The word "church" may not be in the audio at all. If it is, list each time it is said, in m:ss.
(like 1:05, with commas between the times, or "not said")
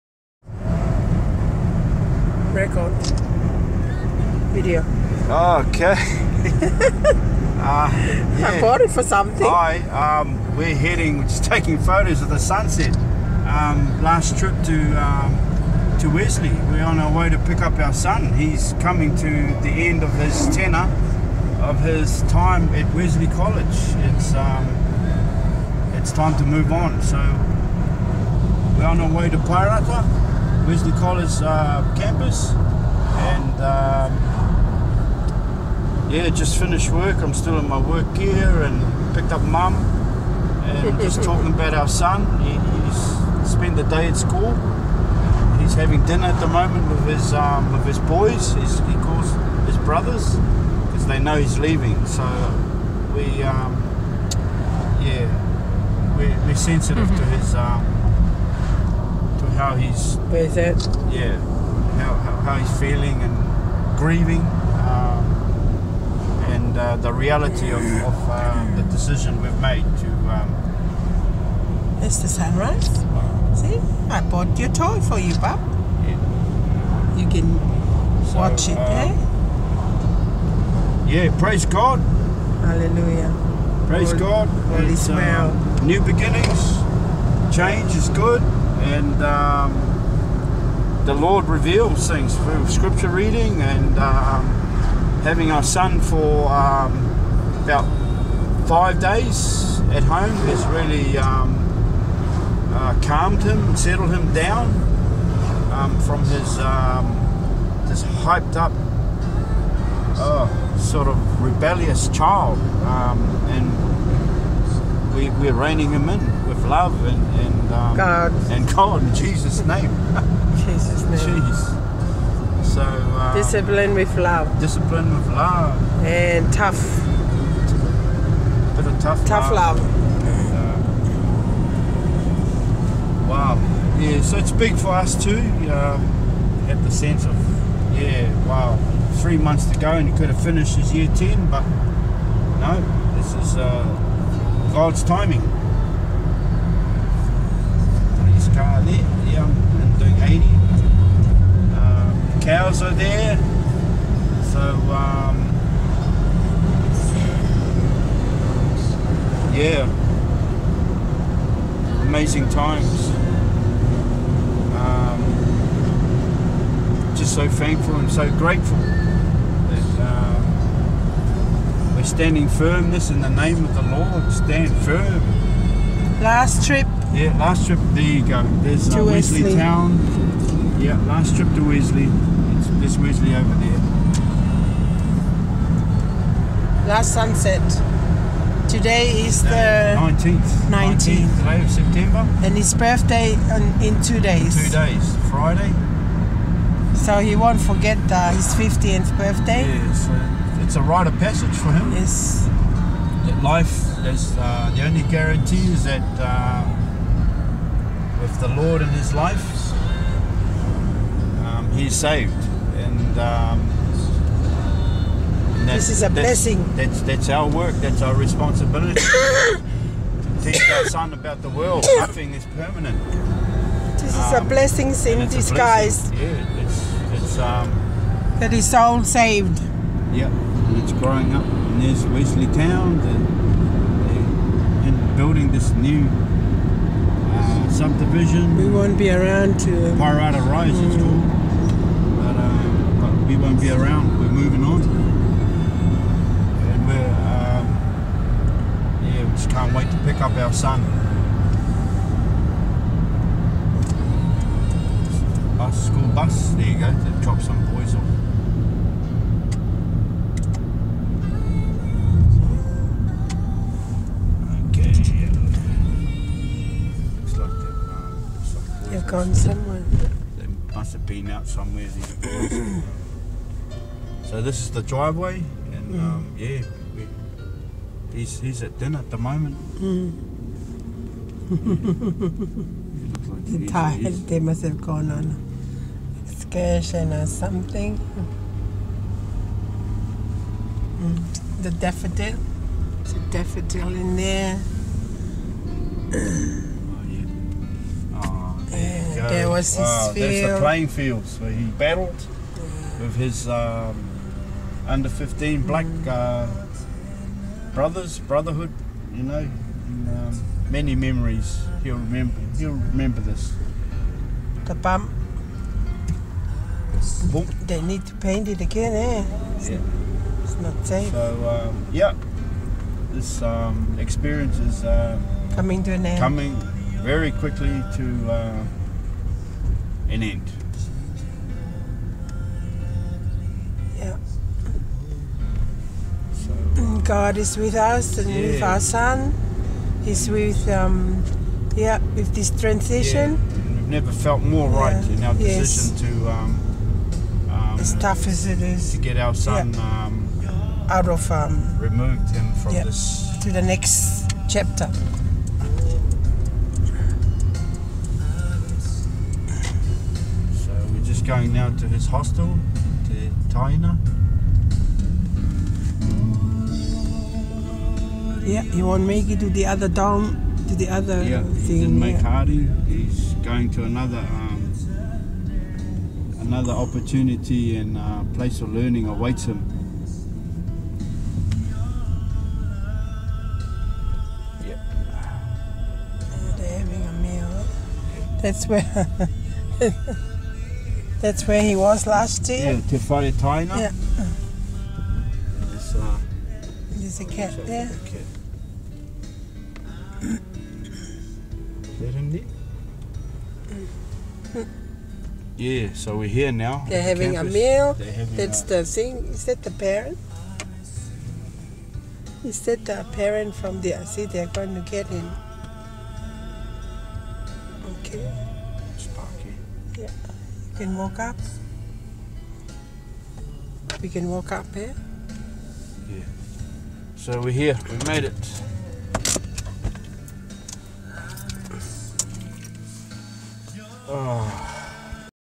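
not said.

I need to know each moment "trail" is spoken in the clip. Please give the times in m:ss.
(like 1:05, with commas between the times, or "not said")
not said.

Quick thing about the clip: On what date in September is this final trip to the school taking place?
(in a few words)
19th.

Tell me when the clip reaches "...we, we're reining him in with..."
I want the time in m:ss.
1:55.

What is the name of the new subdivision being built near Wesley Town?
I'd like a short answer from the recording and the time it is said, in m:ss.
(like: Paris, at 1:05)
Paerata Rise, at 3:59.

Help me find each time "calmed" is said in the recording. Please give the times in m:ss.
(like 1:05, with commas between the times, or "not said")
1:43.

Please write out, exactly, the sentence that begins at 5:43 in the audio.
We've never felt more right in our decision to.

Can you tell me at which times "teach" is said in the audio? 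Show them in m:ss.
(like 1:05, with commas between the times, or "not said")
3:40.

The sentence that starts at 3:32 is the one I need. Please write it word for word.
And, um, and this is a that's, blessing.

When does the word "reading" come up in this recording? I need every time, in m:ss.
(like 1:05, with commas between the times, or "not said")
1:33.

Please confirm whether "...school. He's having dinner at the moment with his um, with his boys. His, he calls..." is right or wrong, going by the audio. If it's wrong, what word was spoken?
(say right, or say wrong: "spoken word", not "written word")
right.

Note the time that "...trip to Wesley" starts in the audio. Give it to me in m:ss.
3:01.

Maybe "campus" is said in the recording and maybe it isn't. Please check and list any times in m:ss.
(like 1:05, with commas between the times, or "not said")
0:31, 6:47.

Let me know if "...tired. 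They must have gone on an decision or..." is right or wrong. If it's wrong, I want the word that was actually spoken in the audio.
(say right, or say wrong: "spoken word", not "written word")
wrong: "excursion", not "decision".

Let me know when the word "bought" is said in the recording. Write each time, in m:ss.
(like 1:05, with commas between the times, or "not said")
0:08, 1:14.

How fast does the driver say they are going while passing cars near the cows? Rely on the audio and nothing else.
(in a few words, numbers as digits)
80.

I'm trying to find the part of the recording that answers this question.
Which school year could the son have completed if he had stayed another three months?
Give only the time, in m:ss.
2:20.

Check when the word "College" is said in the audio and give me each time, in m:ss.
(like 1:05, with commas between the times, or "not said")
0:23, 0:30.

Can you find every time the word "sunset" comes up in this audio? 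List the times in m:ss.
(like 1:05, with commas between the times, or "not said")
0:12, 3:07.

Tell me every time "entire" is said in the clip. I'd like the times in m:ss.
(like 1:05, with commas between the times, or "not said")
not said.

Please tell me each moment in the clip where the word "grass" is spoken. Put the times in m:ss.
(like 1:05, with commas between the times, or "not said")
not said.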